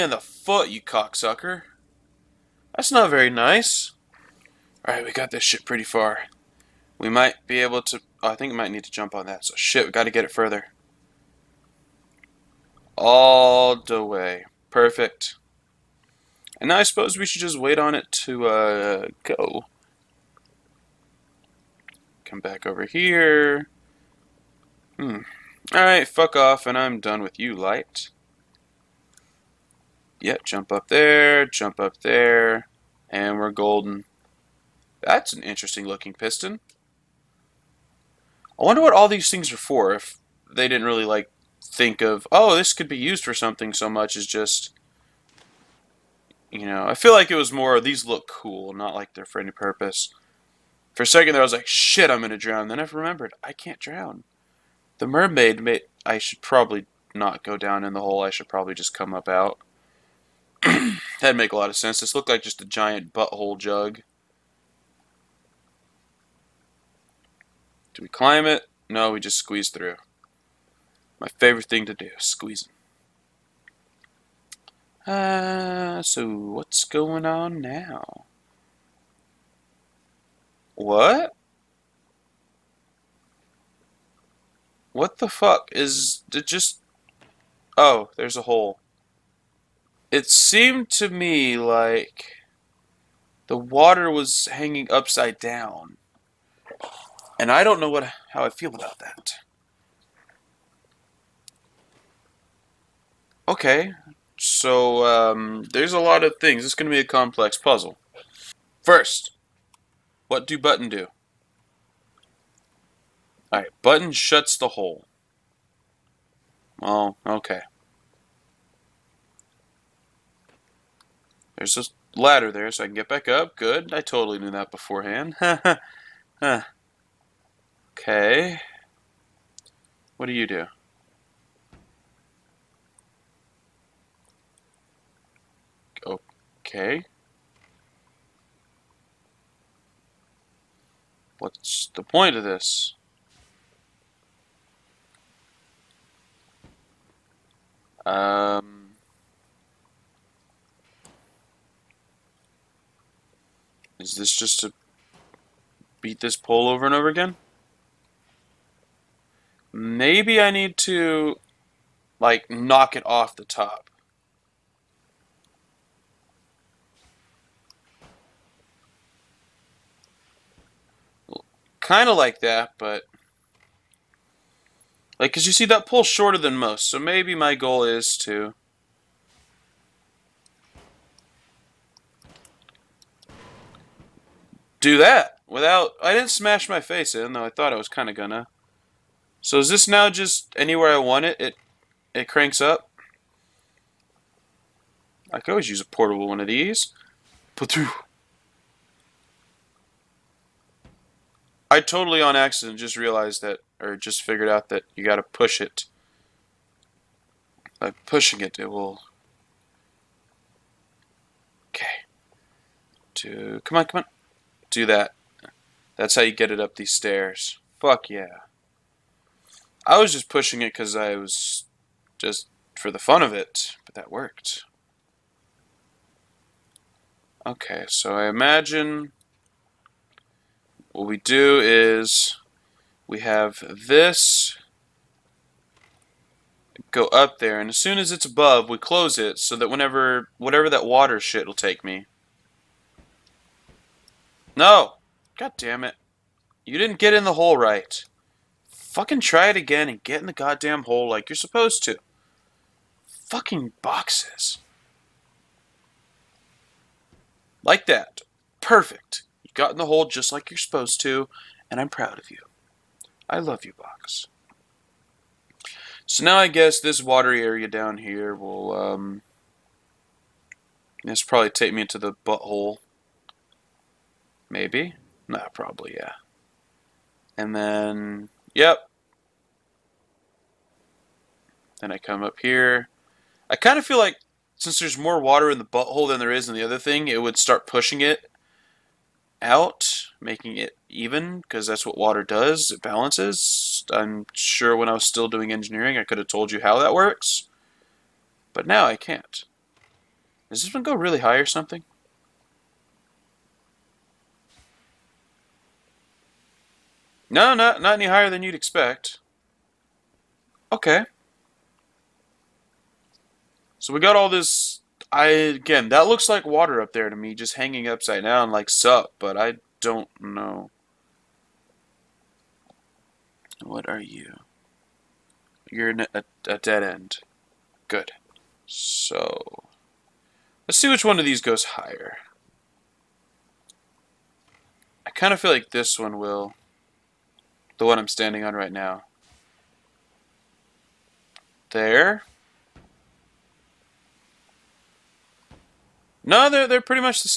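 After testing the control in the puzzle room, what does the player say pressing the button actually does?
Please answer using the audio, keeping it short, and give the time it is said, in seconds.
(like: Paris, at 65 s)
shuts the hole, at 114 s.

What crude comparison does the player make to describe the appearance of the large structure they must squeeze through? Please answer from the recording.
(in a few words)
giant butthole jug.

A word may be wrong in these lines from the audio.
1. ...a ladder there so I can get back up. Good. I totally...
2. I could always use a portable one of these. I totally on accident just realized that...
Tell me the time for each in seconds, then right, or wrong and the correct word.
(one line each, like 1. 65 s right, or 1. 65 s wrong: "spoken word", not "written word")
1. 121 s right
2. 195 s right.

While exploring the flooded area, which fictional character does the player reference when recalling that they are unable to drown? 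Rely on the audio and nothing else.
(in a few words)
The mermaid.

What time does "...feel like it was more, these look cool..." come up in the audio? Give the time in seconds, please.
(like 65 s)
46 s.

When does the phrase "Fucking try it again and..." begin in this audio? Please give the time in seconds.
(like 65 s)
248 s.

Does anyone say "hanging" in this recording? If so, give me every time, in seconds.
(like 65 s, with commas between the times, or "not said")
94 s, 317 s.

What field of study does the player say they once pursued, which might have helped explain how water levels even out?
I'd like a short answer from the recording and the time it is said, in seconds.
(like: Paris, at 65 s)
engineering, at 295 s.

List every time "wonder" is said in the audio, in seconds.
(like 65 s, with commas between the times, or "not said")
38 s.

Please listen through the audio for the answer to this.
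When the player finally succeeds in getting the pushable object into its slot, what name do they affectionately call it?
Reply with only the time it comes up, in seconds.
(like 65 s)
263 s.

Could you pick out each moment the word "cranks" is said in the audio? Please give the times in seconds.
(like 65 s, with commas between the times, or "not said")
192 s.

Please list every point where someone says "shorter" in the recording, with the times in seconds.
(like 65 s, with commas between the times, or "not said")
176 s.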